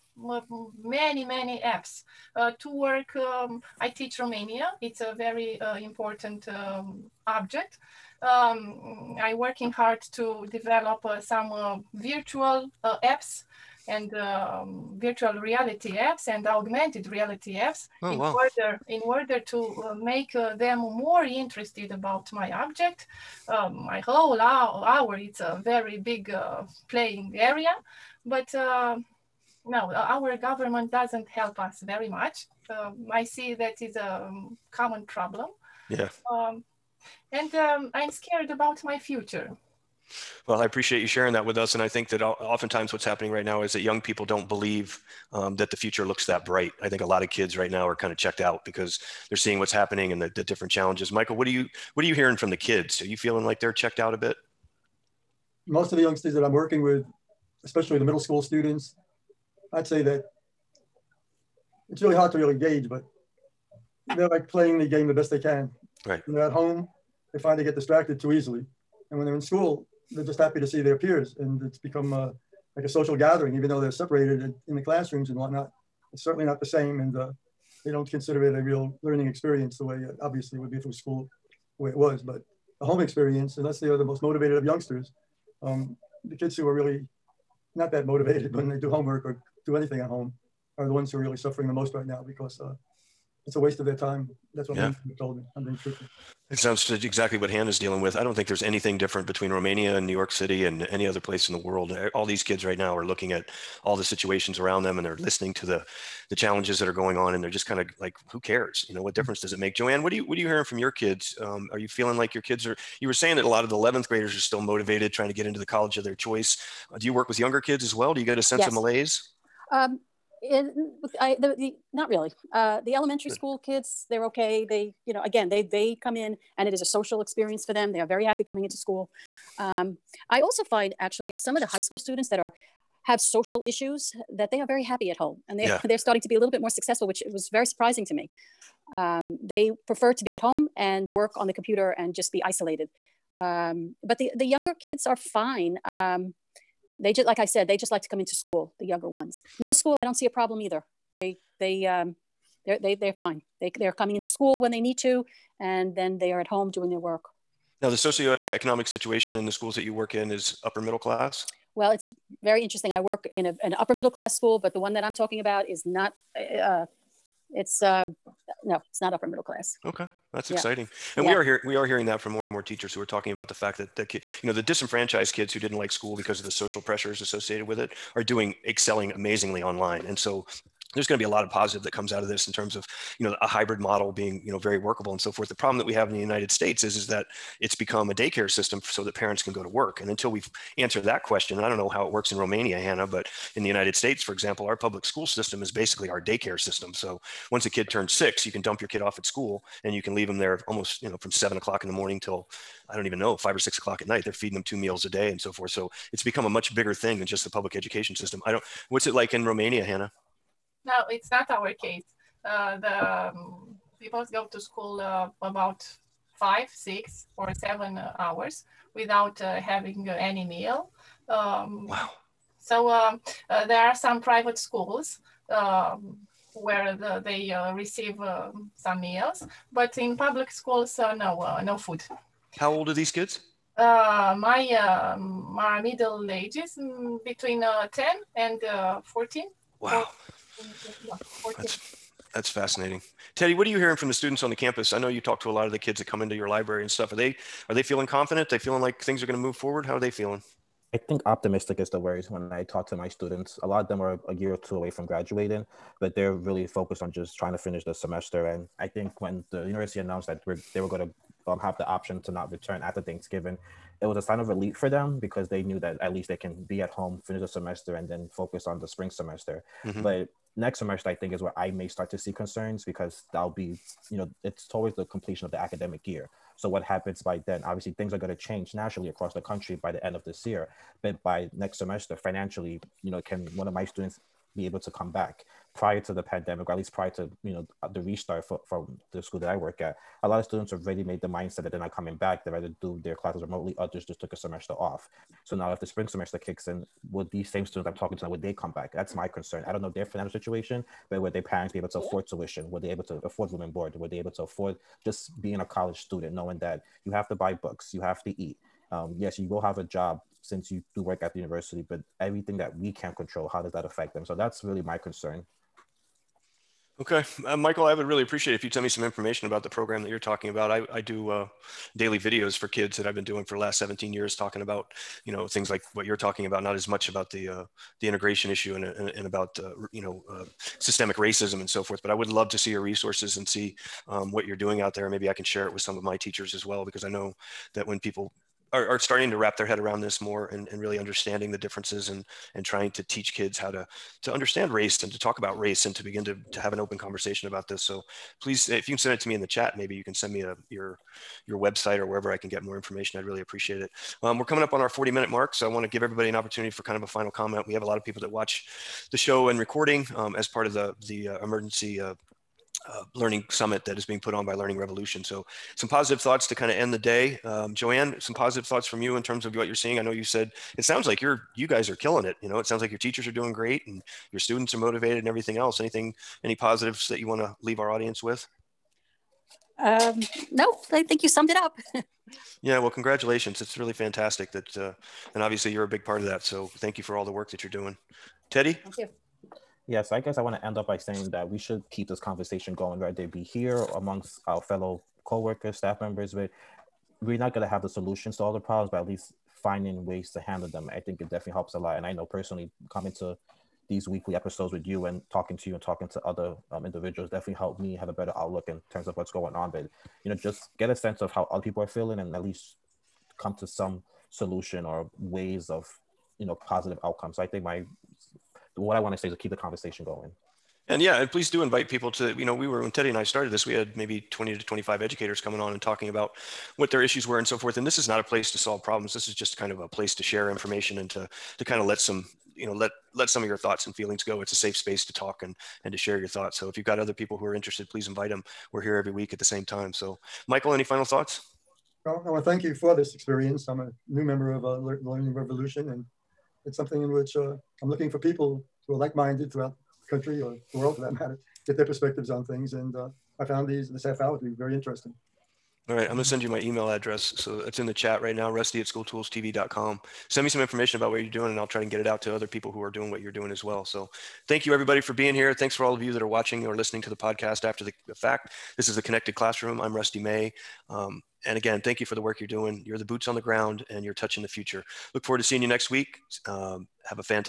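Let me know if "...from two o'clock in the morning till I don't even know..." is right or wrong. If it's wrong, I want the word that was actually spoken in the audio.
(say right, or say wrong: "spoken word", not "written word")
wrong: "seven", not "two".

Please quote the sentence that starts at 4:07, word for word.
Are they are they feeling confident?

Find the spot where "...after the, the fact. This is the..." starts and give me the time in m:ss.
7:47.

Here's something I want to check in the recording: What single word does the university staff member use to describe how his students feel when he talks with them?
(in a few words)
Optimistic.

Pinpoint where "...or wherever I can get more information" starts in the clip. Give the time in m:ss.
5:51.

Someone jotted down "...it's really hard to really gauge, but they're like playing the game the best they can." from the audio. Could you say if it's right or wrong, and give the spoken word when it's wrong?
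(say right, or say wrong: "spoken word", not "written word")
right.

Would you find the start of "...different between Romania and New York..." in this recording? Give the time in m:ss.
1:38.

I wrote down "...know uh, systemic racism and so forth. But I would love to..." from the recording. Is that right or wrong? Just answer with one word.
right.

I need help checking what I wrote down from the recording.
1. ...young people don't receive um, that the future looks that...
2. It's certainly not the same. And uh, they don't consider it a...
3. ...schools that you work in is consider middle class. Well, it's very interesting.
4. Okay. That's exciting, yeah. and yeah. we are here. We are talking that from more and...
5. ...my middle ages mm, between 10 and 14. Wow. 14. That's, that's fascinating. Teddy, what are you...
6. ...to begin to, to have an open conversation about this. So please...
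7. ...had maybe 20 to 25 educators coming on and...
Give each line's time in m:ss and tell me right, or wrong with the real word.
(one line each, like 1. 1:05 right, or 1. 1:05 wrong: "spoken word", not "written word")
1. 0:43 wrong: "believe", not "receive"
2. 1:16 right
3. 2:39 wrong: "upper", not "consider"
4. 2:49 wrong: "hearing", not "talking"
5. 3:55 right
6. 5:45 right
7. 7:03 right.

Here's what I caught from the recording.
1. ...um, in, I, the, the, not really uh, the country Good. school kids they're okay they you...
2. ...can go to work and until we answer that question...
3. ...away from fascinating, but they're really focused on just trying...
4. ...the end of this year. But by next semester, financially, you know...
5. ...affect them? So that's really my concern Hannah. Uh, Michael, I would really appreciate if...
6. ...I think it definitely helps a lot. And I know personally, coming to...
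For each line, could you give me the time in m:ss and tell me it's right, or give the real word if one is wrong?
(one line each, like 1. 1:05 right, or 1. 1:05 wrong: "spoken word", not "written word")
1. 1:59 wrong: "elementary", not "country"
2. 3:09 right
3. 4:14 wrong: "graduating", not "fascinating"
4. 4:39 right
5. 5:13 wrong: "Okay", not "Hannah"
6. 6:40 right.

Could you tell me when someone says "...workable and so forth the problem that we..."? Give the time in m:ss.
3:04.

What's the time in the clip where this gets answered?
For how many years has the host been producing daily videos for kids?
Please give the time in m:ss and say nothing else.
5:23.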